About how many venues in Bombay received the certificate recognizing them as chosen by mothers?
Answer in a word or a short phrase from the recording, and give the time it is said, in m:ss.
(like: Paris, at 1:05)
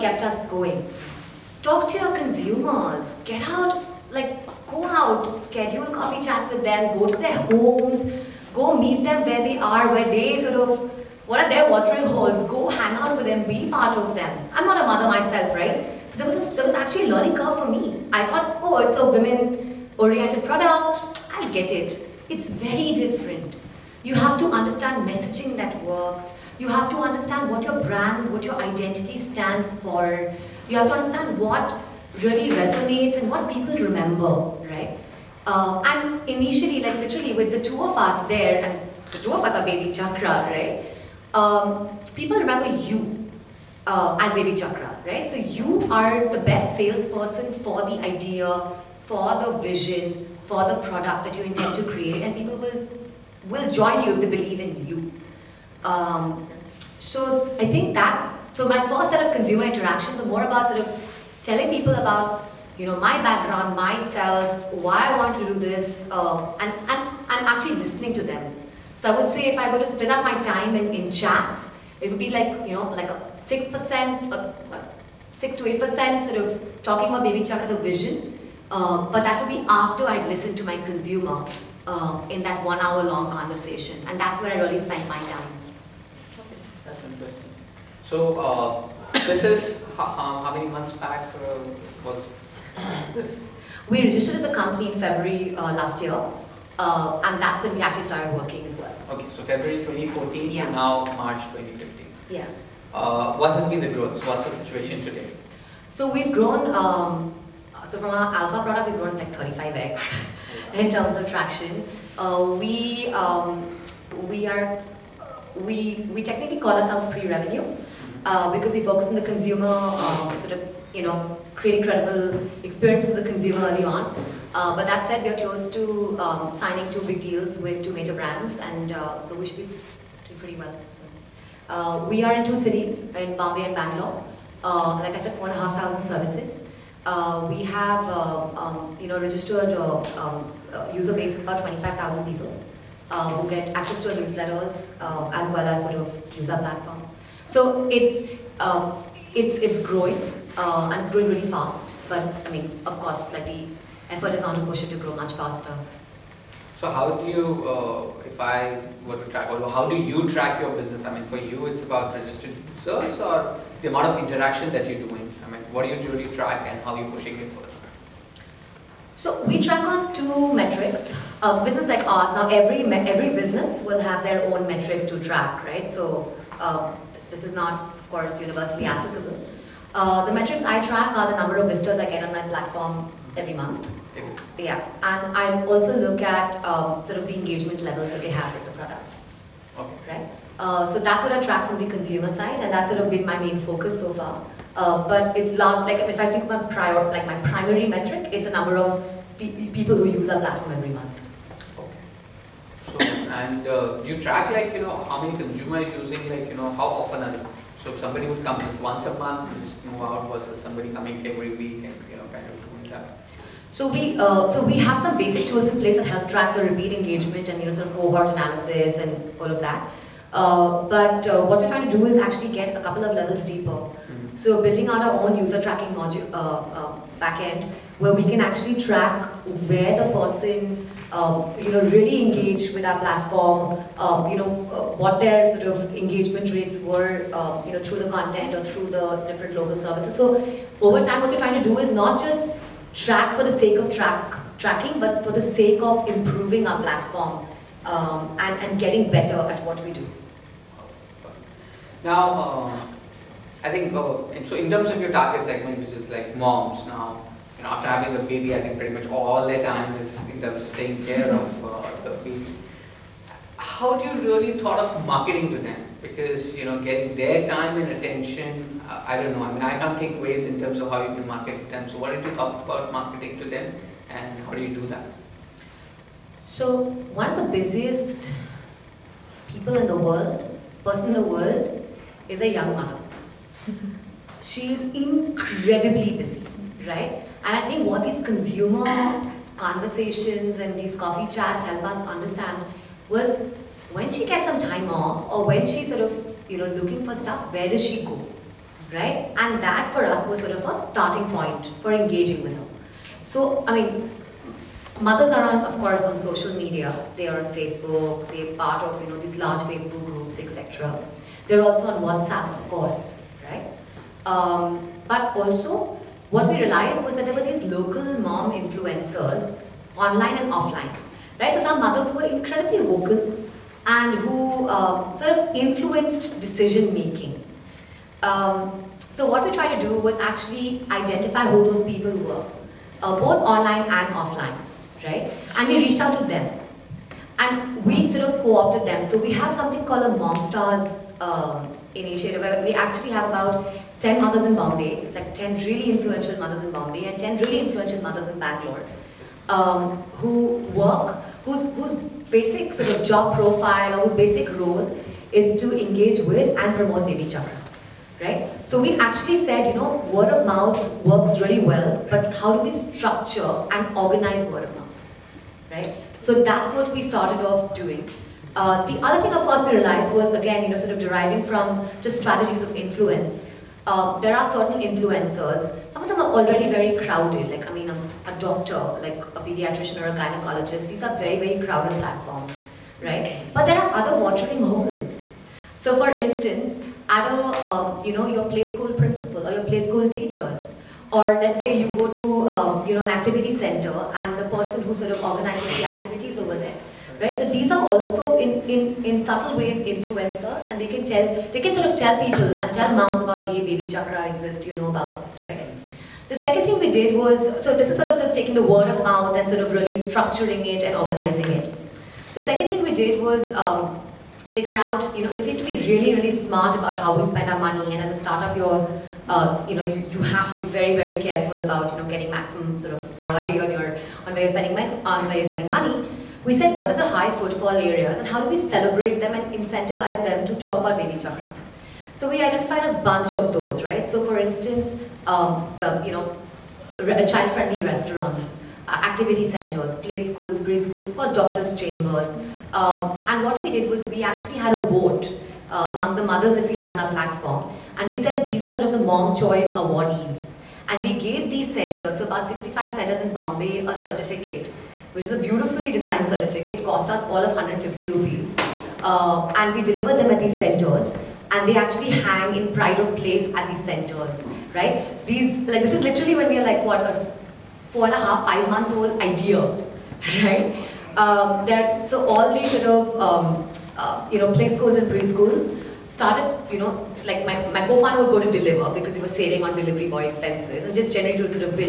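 65, at 7:32.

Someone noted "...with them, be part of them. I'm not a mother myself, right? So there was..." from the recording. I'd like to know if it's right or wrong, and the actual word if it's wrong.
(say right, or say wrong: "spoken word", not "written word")
right.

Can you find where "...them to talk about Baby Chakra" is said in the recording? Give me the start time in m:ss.
7:10.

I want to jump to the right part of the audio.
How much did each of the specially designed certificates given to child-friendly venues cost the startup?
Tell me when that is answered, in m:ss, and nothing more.
7:37.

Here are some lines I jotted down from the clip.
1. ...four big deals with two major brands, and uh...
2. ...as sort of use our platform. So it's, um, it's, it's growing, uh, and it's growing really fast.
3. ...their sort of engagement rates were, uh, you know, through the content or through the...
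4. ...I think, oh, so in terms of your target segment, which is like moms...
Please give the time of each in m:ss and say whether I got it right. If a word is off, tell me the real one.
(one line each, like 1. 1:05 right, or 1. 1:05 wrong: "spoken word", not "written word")
1. 2:06 wrong: "two", not "four"
2. 2:25 right
3. 3:55 right
4. 4:13 right.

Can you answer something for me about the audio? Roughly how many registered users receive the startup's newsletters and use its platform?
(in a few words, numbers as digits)
25,000.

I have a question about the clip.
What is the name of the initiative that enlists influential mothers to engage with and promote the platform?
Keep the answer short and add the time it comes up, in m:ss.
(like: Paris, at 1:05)
Mom Stars, at 5:40.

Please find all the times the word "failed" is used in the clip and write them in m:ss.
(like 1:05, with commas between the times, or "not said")
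not said.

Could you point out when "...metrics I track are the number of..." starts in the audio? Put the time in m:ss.
3:00.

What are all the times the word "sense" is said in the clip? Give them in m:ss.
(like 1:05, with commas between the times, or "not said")
not said.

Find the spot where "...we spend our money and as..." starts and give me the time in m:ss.
6:57.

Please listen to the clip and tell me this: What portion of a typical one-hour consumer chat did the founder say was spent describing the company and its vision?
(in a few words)
6 to 8 percent.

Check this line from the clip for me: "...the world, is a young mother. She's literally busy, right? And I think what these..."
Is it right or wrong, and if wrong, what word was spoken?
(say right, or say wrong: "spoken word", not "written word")
wrong: "incredibly", not "literally".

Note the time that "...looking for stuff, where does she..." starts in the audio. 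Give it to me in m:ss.
4:56.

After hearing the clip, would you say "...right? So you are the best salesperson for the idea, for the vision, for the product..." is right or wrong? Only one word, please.
right.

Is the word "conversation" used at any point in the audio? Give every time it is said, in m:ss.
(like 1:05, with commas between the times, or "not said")
1:23, 4:49.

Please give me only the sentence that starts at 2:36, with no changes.
So how do you, uh, if I were to track, or how do you track your business?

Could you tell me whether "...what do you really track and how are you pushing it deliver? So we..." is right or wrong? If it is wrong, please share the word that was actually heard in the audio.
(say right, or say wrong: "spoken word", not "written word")
wrong: "further", not "deliver".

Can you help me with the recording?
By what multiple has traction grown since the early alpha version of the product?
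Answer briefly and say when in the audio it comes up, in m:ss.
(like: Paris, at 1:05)
35x, at 1:49.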